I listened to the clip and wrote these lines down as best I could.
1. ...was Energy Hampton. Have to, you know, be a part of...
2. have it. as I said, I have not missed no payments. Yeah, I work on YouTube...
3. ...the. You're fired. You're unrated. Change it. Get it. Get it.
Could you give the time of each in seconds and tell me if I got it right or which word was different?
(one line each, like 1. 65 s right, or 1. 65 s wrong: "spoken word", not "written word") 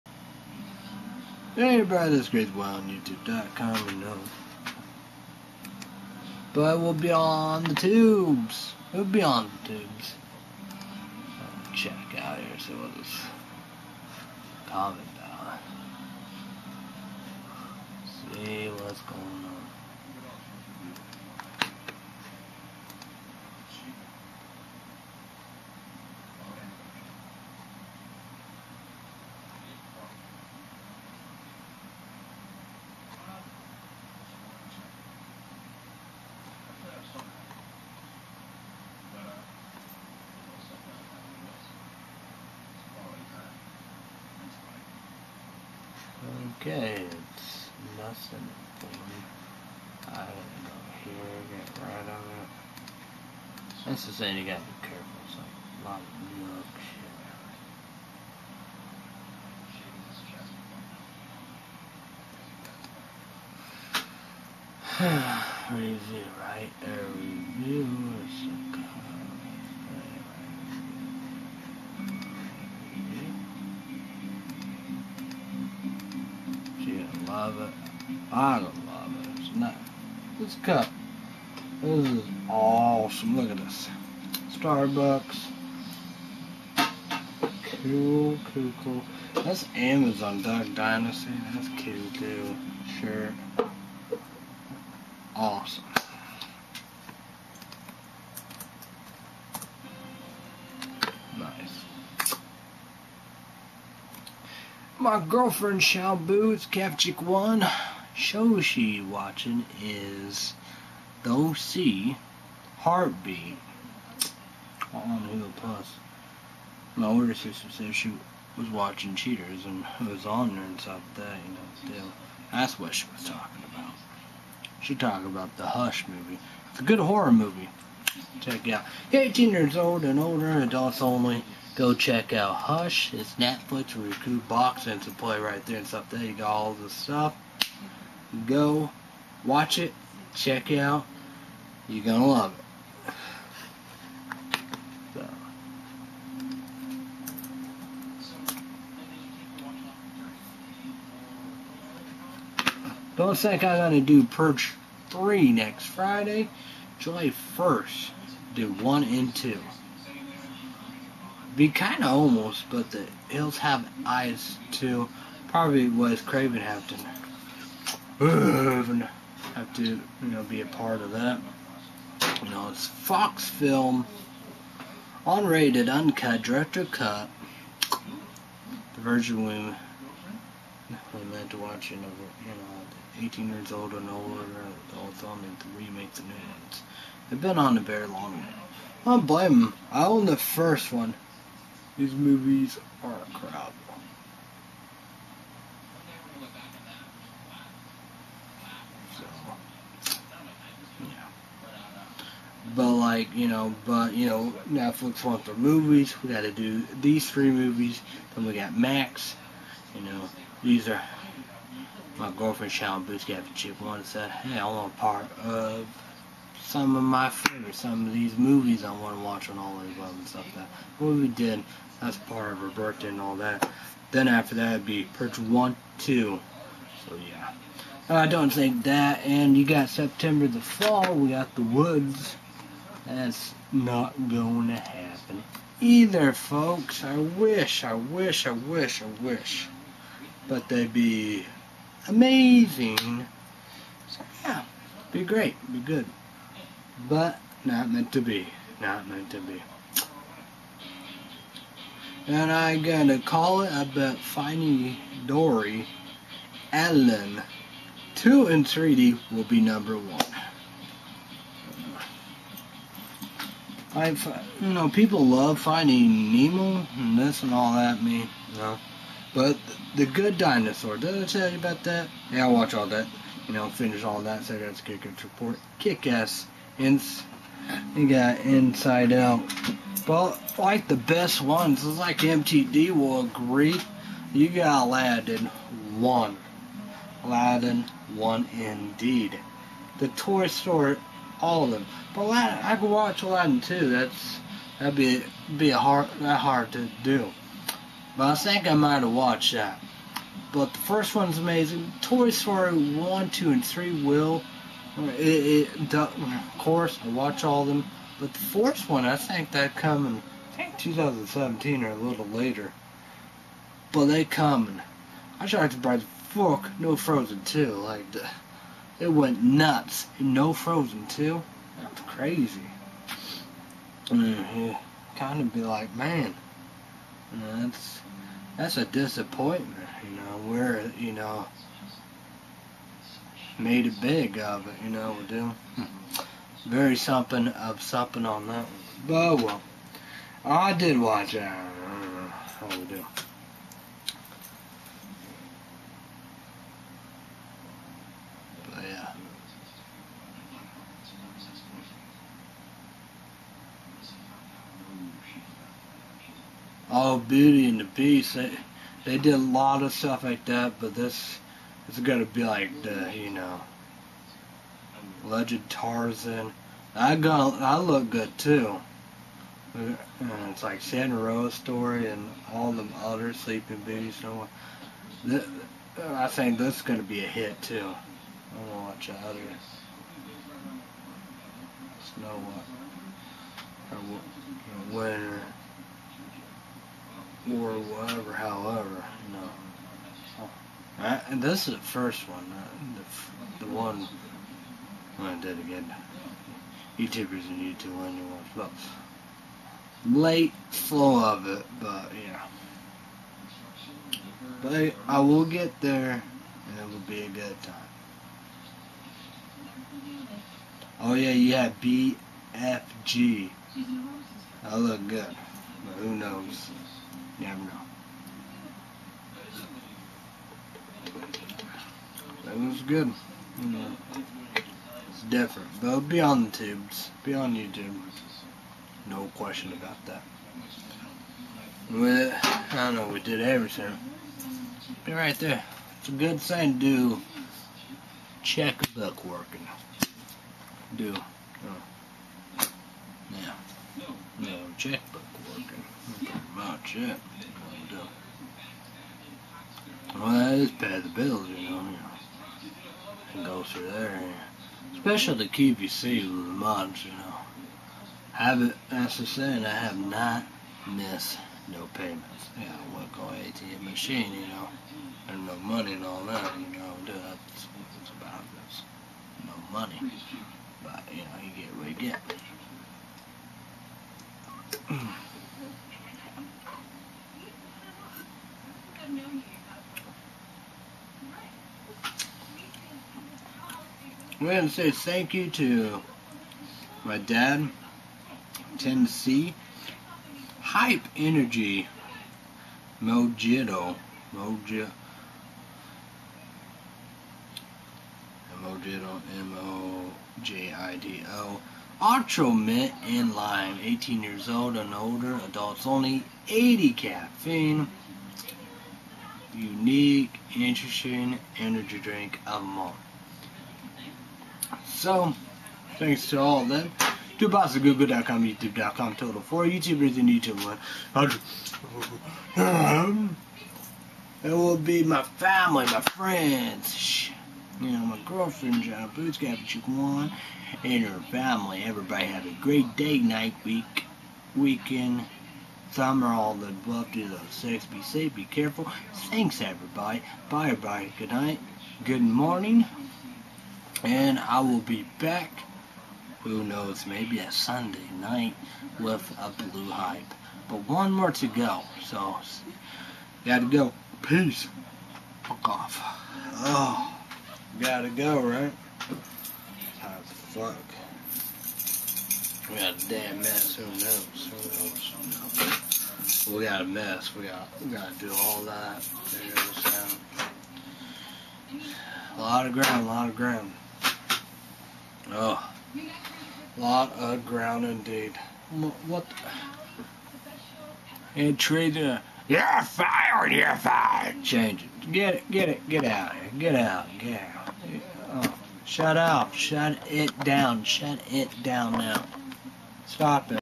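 1. 165 s wrong: "Craven", not "Energy"
2. 458 s wrong: "ATM", not "YouTube"
3. 581 s wrong: "fired", not "unrated".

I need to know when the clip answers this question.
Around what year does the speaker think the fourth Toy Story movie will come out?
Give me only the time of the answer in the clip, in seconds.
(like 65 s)
310 s.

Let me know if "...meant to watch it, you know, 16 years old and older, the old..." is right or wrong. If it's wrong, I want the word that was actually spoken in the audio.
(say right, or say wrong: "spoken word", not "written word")
wrong: "18", not "16".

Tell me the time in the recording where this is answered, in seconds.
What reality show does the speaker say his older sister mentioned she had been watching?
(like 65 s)
119 s.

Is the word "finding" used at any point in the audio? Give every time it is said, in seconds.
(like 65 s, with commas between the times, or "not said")
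254 s, 265 s.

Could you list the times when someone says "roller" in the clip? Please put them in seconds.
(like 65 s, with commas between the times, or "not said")
not said.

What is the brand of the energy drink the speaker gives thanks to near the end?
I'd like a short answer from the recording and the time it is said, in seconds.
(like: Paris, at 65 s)
Hype Energy, at 490 s.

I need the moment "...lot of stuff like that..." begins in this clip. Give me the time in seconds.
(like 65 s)
359 s.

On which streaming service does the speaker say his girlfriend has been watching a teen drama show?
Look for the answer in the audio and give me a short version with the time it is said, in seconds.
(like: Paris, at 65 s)
Hulu Plus, at 115 s.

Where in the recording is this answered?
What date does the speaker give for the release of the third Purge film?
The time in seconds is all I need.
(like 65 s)
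156 s.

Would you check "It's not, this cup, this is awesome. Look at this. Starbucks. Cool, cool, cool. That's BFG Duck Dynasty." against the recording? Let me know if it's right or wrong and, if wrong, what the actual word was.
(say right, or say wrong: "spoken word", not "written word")
wrong: "Amazon", not "BFG".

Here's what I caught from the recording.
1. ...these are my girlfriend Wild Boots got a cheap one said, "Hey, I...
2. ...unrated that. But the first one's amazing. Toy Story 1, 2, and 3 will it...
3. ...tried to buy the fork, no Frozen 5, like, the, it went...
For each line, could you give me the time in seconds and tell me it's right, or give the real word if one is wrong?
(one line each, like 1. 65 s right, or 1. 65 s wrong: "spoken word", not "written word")
1. 210 s wrong: "Shannon", not "Wild"
2. 299 s wrong: "watched", not "unrated"
3. 315 s wrong: "2", not "5".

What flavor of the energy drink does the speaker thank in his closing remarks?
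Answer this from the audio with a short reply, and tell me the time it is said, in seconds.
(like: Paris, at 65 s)
Ultra Mint and Lime, at 502 s.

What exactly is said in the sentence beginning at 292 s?
But Aladdin, I could watch Aladdin 2.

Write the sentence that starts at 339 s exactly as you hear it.
But well, I did watch it.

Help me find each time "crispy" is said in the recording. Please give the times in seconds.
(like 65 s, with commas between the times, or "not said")
not said.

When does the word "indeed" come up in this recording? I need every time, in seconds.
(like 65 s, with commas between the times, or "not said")
288 s, 577 s.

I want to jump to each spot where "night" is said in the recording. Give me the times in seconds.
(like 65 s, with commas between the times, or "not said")
533 s, 541 s, 548 s.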